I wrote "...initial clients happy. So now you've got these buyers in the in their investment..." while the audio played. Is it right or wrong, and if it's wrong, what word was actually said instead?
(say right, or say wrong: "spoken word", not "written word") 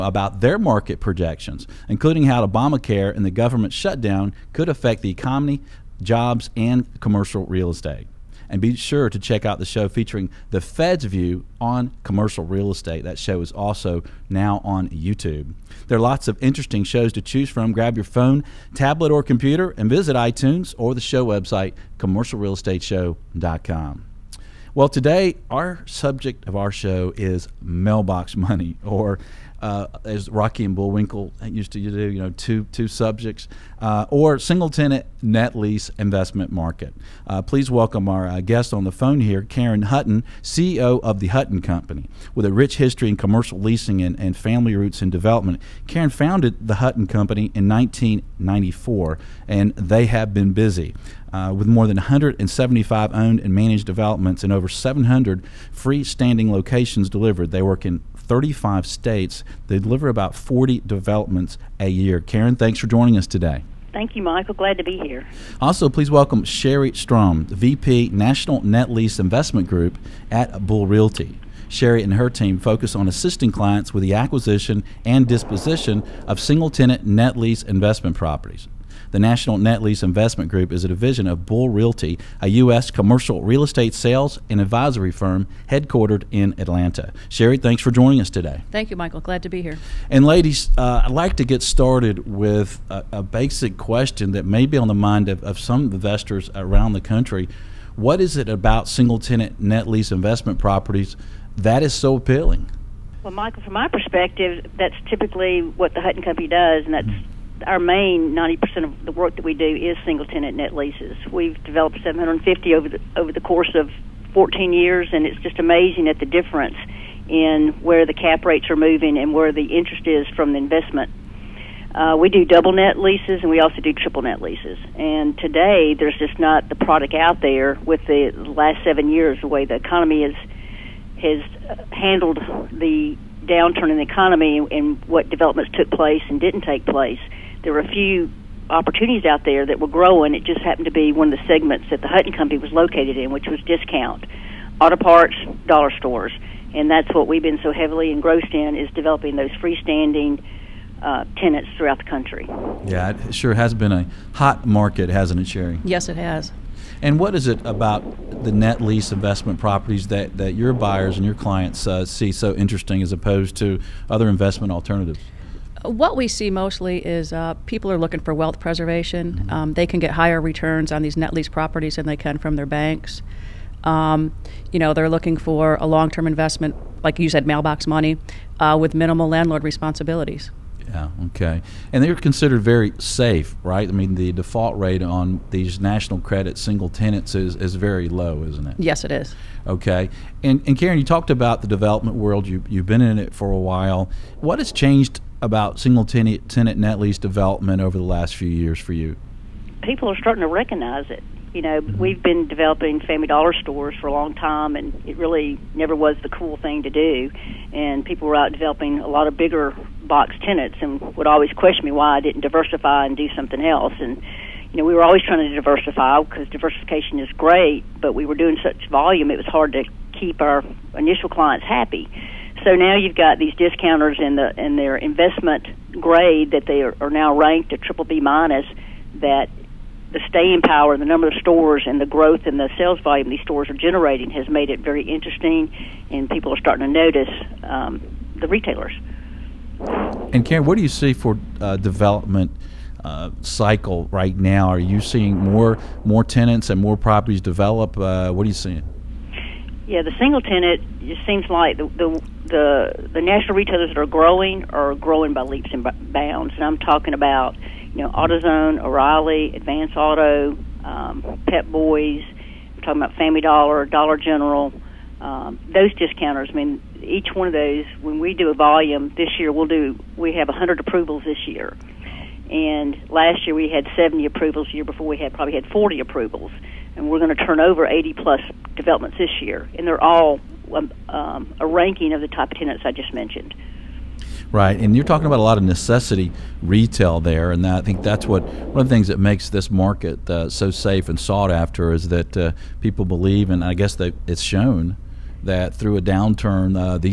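wrong: "discounters", not "buyers".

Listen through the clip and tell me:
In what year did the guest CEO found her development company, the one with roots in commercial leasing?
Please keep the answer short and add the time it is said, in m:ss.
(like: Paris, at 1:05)
1994, at 0:47.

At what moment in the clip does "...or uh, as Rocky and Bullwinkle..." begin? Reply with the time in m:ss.
0:28.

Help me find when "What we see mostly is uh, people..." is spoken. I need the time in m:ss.
2:45.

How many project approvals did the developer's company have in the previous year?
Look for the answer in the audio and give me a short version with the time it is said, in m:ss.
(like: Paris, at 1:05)
70, at 4:33.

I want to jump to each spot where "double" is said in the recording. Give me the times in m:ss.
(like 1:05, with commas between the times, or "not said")
2:02.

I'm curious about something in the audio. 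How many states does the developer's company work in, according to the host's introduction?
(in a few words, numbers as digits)
35.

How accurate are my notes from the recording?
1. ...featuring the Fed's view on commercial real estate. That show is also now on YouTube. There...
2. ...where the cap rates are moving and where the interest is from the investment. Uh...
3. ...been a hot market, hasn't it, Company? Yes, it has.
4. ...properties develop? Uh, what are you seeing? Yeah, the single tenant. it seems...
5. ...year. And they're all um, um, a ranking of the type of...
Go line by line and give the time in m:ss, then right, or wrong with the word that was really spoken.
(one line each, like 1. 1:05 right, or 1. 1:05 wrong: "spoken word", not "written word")
1. 0:09 right
2. 1:57 right
3. 2:33 wrong: "Sherry", not "Company"
4. 4:06 right
5. 4:39 right.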